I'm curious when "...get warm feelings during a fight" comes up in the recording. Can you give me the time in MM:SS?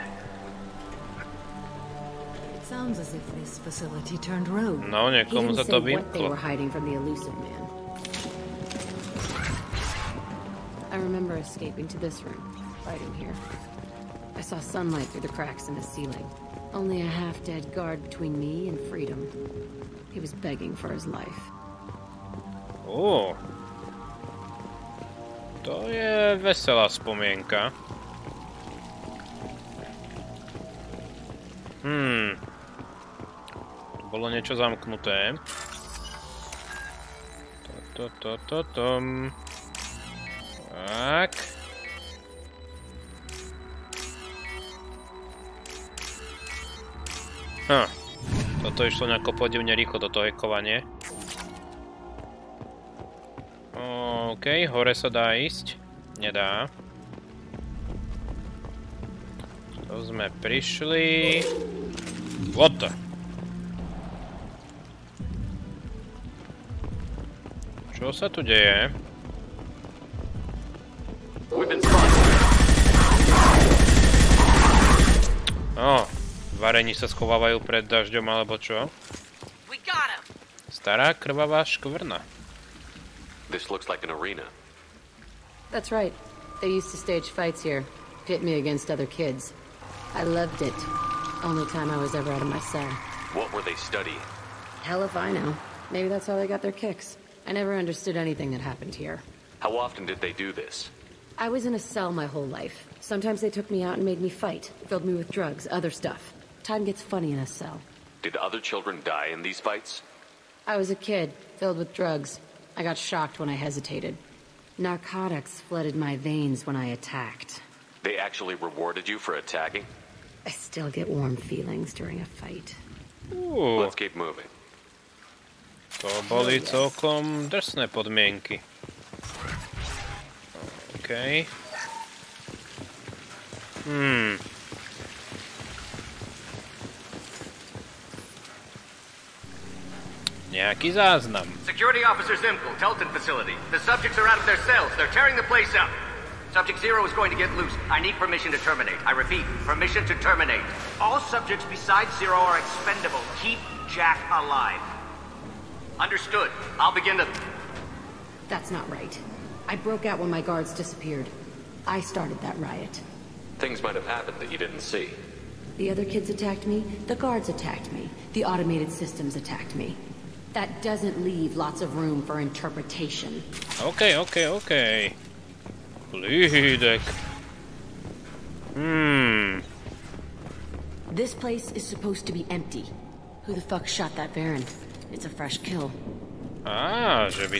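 02:00.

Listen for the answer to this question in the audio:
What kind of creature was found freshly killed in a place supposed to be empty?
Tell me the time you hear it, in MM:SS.
03:04.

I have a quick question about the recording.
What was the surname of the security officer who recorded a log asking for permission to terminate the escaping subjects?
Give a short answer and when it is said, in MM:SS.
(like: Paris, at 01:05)
Zimkel, at 02:22.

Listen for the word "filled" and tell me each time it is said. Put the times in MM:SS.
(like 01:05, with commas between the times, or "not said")
01:44, 01:51.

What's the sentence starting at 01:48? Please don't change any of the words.
Did other children die in these fights?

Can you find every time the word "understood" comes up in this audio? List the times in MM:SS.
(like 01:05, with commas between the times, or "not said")
01:37, 02:35.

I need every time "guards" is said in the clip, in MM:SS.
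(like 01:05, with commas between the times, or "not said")
00:17, 02:40, 02:47.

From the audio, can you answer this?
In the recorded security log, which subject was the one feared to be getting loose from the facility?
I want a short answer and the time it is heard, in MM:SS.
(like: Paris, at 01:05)
Subject Zero, at 02:26.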